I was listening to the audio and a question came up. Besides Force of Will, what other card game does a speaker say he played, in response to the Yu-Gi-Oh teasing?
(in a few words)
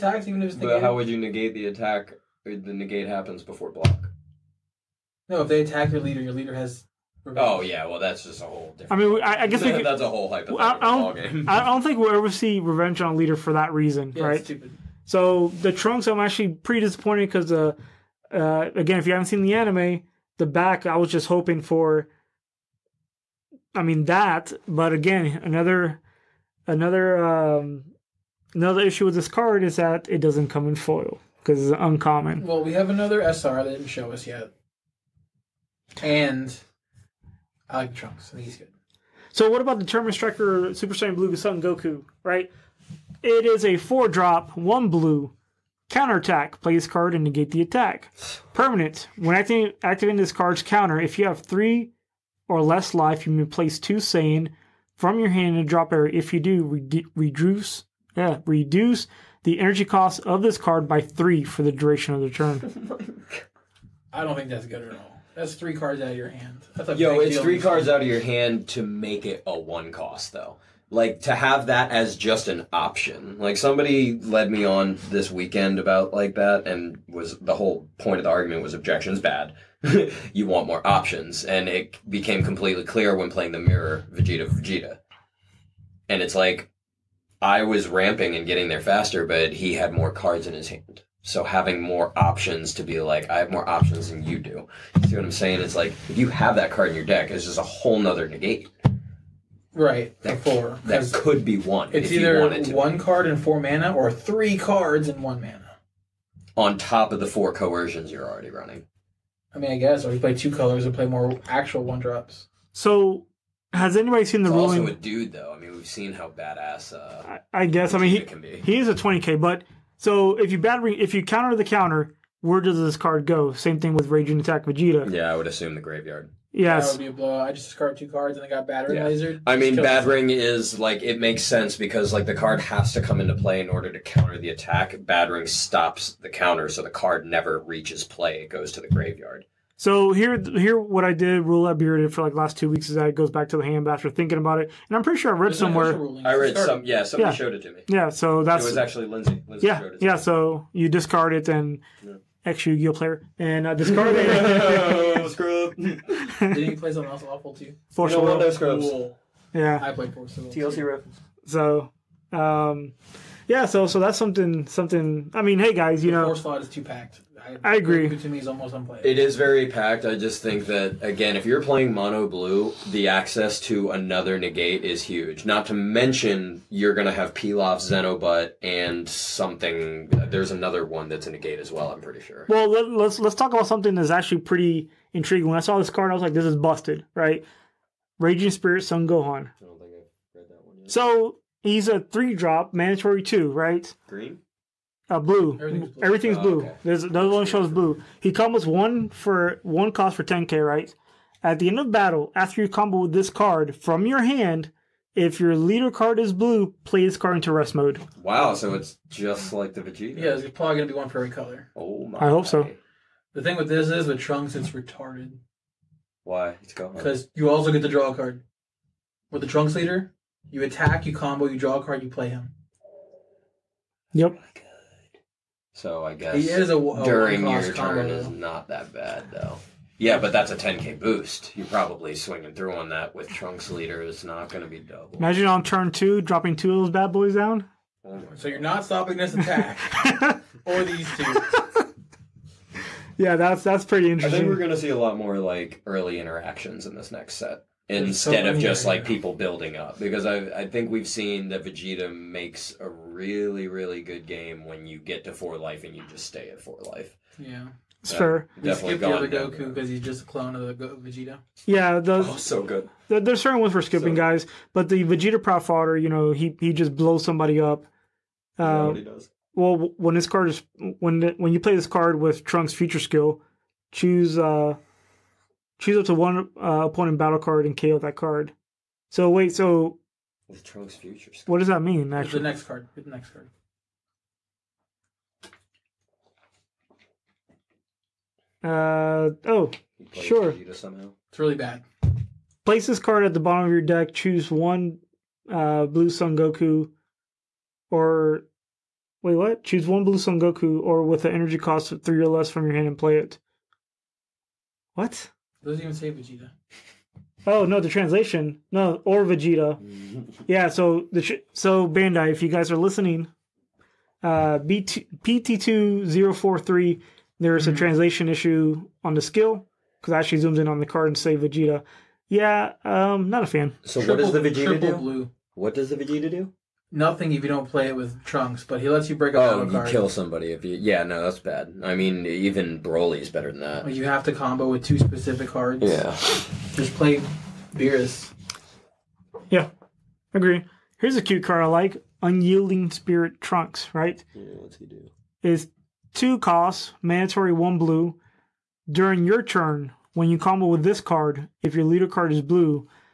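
TLC.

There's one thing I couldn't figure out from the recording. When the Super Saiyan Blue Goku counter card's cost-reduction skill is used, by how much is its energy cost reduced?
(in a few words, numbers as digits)
3.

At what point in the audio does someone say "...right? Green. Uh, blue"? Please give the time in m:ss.
3:13.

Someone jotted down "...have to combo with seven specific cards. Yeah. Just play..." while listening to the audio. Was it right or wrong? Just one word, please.
wrong.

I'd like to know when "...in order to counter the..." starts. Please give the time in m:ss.
2:13.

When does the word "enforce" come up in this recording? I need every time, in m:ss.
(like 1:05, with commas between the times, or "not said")
not said.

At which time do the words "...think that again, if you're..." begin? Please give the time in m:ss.
2:50.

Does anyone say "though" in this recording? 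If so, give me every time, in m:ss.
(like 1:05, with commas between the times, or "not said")
1:10, 1:55, 3:49.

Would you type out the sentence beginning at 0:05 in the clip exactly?
No, if they attack your leader, your leader has.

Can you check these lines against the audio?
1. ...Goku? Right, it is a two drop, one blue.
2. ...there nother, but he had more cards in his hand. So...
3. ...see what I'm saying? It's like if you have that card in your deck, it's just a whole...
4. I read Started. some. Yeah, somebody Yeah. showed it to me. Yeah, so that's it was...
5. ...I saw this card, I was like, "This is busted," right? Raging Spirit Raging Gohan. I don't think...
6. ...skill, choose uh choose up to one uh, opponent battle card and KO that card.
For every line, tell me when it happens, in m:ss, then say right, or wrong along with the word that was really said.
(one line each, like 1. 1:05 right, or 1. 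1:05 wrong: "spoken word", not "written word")
1. 0:41 wrong: "four", not "two"
2. 1:28 wrong: "faster", not "nother"
3. 1:35 right
4. 2:26 right
5. 3:05 wrong: "Son", not "Raging"
6. 4:32 right.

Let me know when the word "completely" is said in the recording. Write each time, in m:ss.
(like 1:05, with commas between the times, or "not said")
1:22.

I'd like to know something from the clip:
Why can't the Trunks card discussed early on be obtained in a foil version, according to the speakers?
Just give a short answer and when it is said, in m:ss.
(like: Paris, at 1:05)
it's uncommon, at 0:31.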